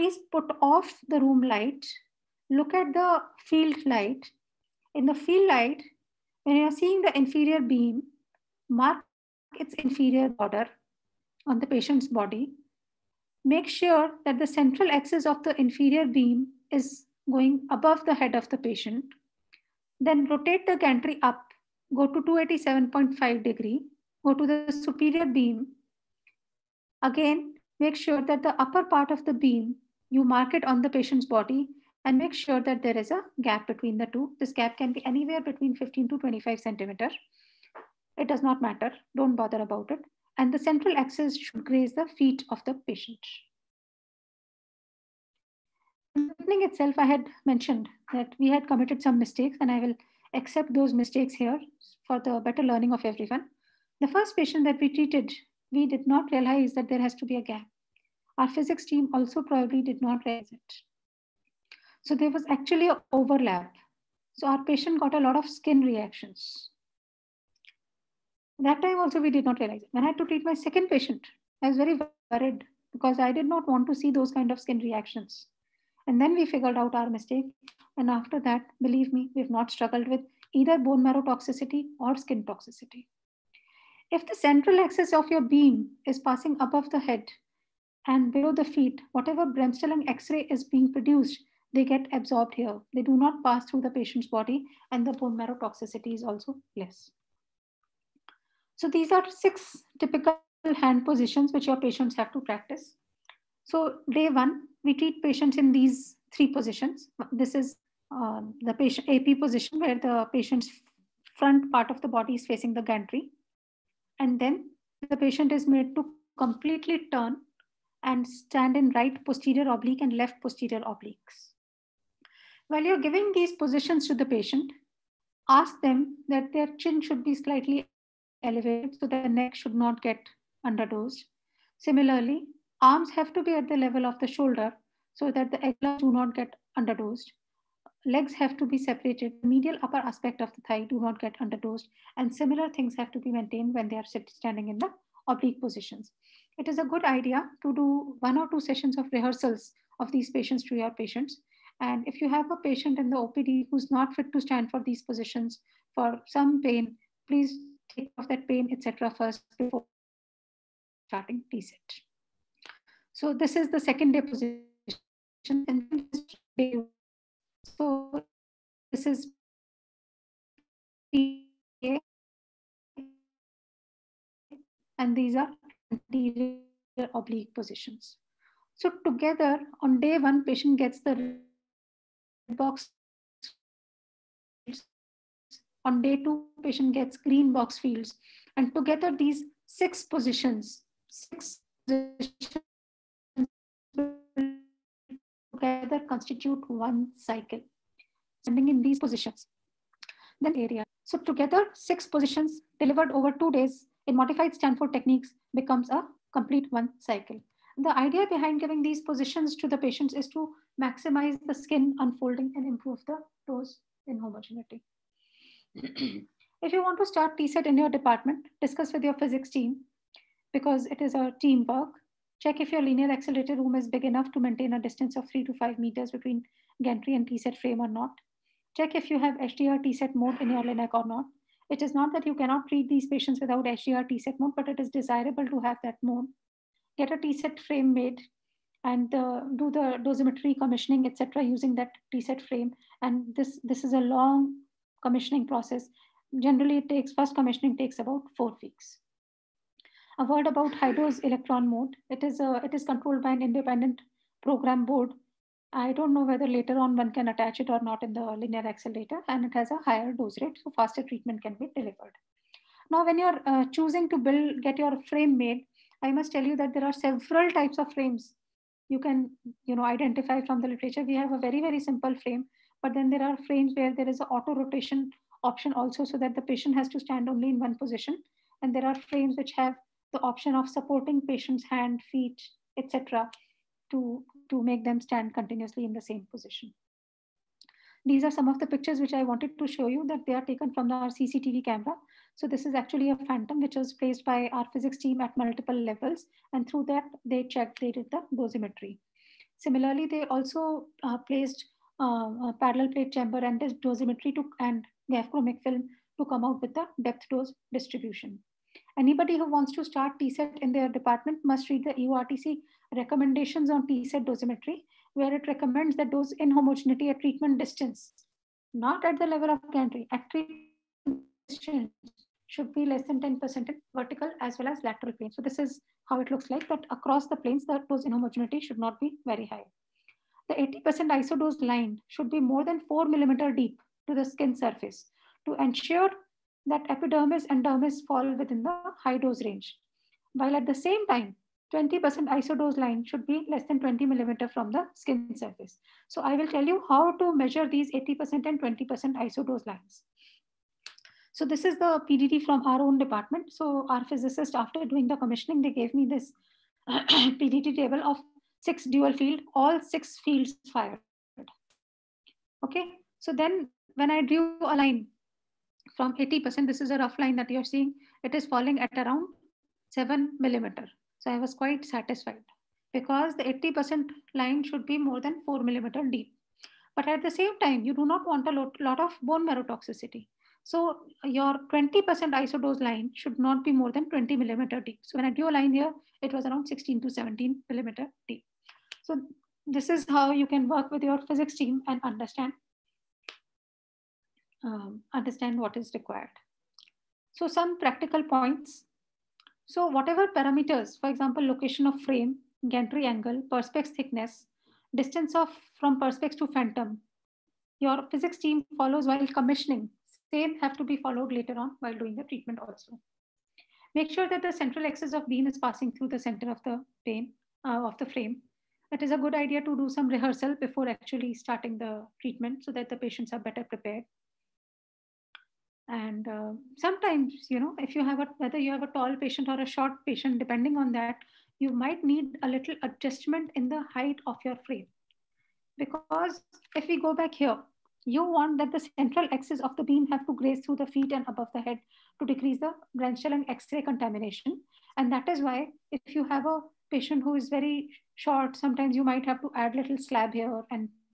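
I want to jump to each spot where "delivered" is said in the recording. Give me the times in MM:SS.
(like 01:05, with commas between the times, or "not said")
03:22, 04:21.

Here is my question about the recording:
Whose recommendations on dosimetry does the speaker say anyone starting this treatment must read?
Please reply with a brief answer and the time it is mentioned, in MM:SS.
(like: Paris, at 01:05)
EORTC, at 05:11.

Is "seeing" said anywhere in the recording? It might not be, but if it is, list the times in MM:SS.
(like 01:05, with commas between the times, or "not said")
00:06, 06:07.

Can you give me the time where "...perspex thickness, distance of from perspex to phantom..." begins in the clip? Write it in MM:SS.
06:43.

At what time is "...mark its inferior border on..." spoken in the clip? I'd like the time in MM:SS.
00:08.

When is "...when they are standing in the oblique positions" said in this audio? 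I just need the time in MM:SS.
02:23.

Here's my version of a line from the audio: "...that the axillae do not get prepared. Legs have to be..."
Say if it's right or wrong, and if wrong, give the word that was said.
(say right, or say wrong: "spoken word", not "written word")
wrong: "underdosed", not "prepared".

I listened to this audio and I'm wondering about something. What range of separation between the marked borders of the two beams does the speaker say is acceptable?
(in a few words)
15 to 25 centimeters.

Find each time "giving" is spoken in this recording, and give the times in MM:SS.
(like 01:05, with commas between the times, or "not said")
02:03, 03:28.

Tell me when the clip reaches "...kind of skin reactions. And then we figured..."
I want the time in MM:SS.
01:14.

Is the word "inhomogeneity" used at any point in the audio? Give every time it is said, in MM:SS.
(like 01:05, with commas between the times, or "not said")
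05:16, 05:28.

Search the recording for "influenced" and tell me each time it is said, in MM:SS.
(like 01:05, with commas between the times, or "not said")
not said.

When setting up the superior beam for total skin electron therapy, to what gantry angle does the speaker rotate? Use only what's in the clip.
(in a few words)
287.5 degrees.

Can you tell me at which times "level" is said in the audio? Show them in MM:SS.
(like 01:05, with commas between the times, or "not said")
02:13, 04:55, 05:19.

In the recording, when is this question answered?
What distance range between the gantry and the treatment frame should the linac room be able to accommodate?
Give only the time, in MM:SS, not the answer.
03:45.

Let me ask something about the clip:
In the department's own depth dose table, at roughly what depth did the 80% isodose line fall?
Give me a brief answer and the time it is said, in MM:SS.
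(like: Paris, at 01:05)
7 millimeters, at 06:09.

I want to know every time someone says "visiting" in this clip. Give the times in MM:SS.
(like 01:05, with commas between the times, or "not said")
not said.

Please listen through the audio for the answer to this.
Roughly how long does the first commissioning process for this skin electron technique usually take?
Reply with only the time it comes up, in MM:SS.
04:08.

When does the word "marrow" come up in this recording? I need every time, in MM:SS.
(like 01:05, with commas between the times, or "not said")
01:21, 01:35, 06:19.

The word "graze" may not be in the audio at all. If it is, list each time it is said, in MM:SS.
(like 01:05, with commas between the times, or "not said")
00:41, 07:20.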